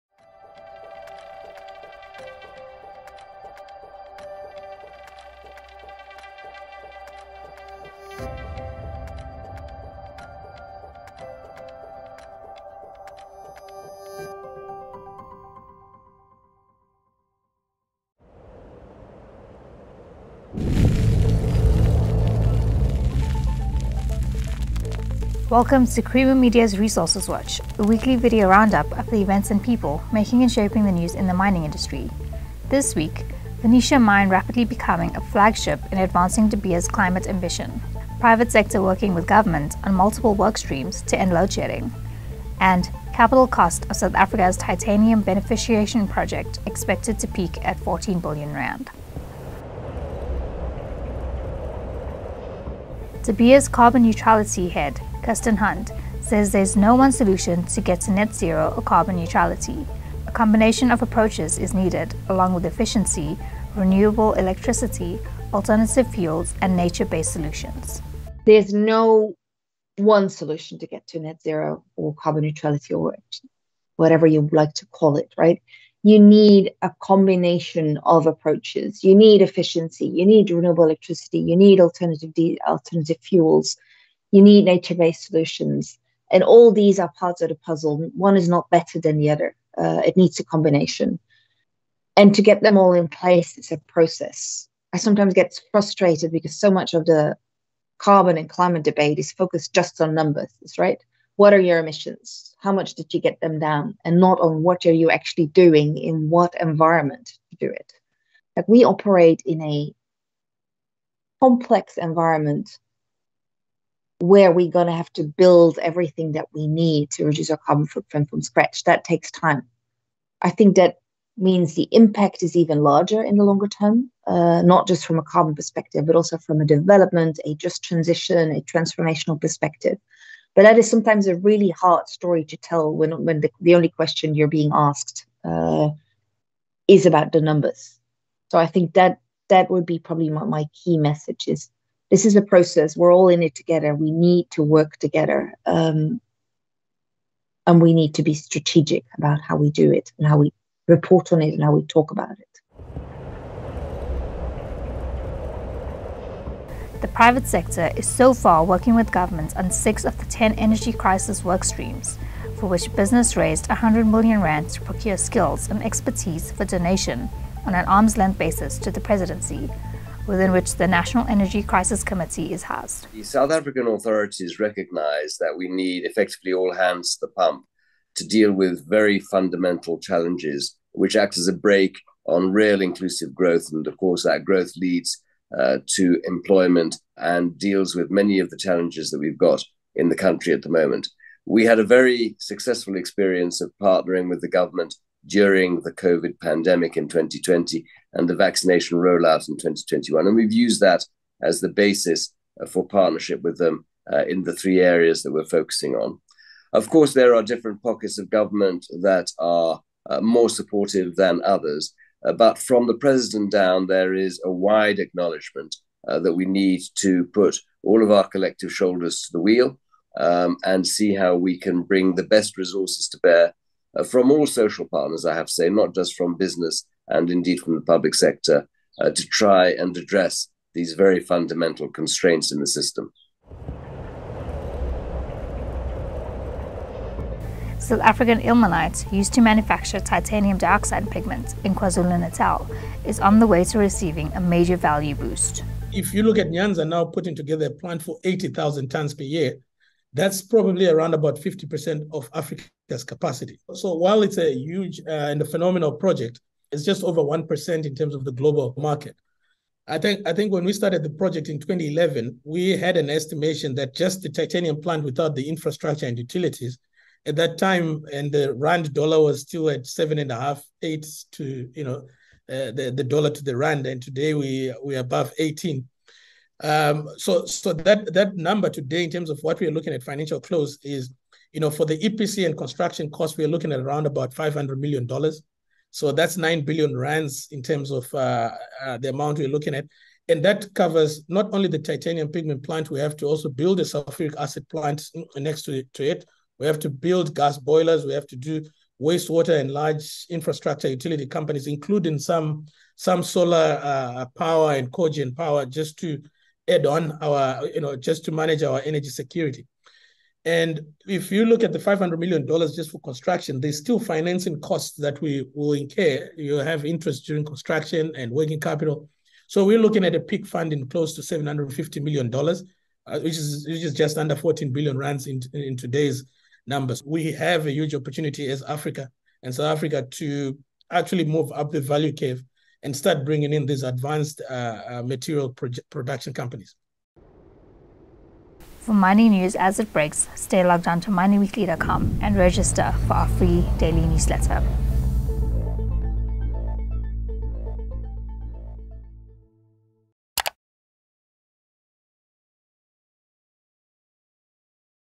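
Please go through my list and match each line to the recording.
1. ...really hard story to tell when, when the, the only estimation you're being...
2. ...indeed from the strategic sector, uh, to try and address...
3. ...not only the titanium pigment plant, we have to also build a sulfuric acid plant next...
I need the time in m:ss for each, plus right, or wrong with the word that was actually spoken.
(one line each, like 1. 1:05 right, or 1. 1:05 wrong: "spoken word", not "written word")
1. 2:11 wrong: "question", not "estimation"
2. 3:47 wrong: "public", not "strategic"
3. 4:51 right.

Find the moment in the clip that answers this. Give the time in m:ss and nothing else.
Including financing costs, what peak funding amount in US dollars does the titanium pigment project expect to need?
5:21.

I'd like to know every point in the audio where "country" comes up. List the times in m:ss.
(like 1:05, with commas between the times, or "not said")
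3:10.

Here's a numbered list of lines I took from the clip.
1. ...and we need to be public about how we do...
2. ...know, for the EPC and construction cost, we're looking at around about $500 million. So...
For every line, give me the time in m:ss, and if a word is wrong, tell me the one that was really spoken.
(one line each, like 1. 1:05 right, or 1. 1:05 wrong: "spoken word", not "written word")
1. 2:27 wrong: "strategic", not "public"
2. 4:41 right.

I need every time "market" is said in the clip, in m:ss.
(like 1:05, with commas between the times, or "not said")
4:18.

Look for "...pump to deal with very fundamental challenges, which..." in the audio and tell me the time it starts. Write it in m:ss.
2:57.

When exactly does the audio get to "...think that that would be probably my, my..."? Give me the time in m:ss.
2:18.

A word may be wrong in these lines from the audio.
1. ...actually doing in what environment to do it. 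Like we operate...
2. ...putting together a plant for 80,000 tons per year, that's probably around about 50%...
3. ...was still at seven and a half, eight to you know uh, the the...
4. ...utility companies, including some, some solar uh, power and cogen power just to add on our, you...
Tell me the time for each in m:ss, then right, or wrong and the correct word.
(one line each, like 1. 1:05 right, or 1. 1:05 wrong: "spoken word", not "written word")
1. 1:45 right
2. 4:07 right
3. 4:29 right
4. 5:00 right.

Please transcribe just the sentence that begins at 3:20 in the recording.
And we've used that as the basis uh, for partnership with them uh, in the three areas that we're focusing on.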